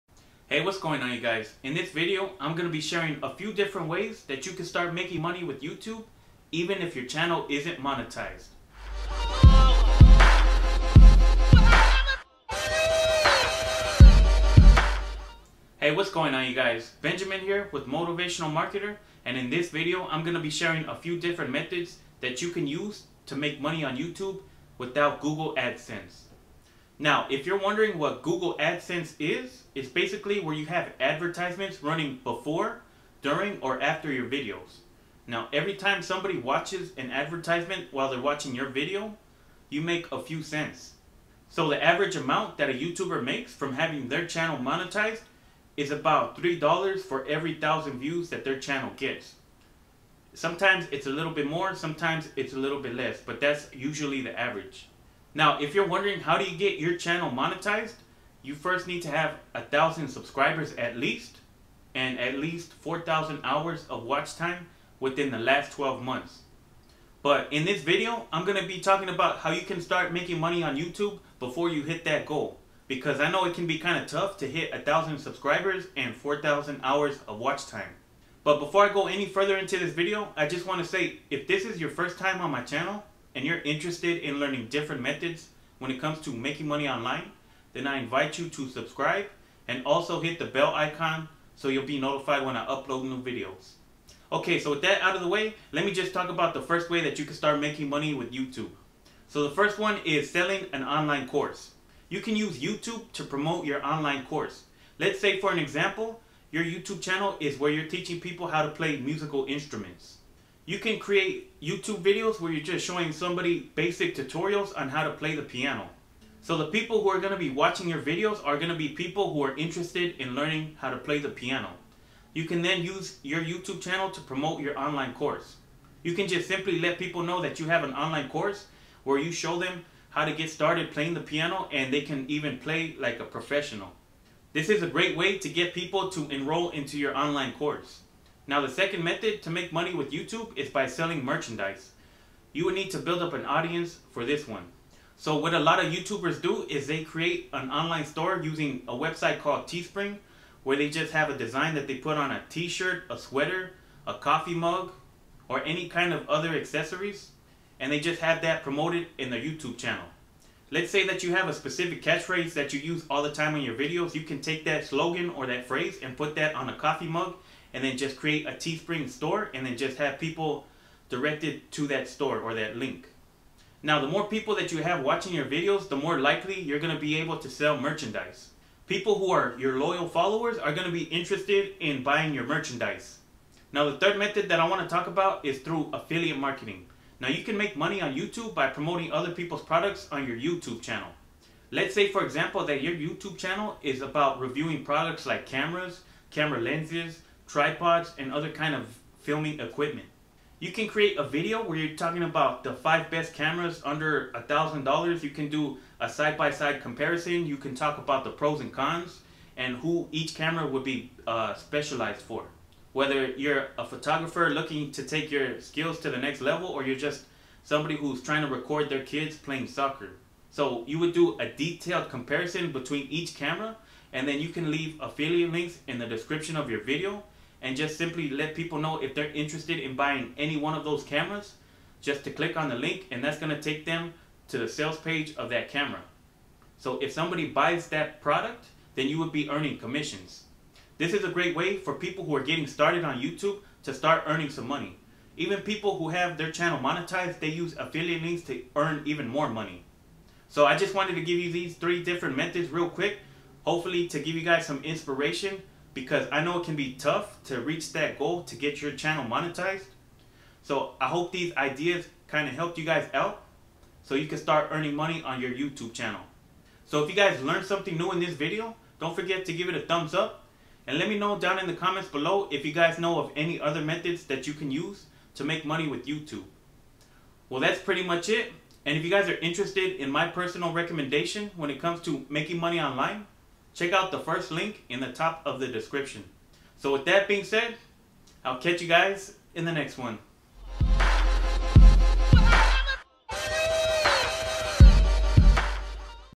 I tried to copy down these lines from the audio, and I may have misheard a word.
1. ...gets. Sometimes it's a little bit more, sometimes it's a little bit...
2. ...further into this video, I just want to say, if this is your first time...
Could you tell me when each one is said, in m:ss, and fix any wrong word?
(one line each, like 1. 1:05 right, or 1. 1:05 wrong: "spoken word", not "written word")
1. 0:48 right
2. 1:19 right.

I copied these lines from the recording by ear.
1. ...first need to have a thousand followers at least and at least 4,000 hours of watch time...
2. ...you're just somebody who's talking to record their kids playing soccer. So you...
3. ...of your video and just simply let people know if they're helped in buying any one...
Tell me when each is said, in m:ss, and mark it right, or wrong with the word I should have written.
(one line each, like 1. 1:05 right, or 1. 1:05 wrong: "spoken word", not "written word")
1. 0:58 wrong: "subscribers", not "followers"
2. 3:36 wrong: "trying", not "talking"
3. 3:46 wrong: "interested", not "helped".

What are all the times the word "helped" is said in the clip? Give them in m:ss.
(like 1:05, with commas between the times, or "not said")
4:22.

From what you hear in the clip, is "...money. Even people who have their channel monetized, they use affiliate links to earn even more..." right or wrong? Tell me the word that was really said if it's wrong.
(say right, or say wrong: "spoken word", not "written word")
right.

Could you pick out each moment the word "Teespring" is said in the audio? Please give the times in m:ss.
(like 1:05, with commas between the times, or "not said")
2:29, 2:48.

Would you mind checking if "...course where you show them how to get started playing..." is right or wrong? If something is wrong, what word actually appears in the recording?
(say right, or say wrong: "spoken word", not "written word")
right.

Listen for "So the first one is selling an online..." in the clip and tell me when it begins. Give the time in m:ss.
1:39.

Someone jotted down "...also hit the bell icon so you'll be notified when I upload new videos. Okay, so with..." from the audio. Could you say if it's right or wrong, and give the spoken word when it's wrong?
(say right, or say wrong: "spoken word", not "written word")
right.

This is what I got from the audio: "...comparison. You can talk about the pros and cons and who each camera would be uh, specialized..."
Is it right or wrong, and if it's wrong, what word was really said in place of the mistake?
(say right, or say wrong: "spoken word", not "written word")
right.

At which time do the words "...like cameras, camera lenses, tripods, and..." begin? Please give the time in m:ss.
3:15.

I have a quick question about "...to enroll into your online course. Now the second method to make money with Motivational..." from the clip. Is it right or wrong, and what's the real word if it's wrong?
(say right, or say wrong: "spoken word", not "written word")
wrong: "YouTube", not "Motivational".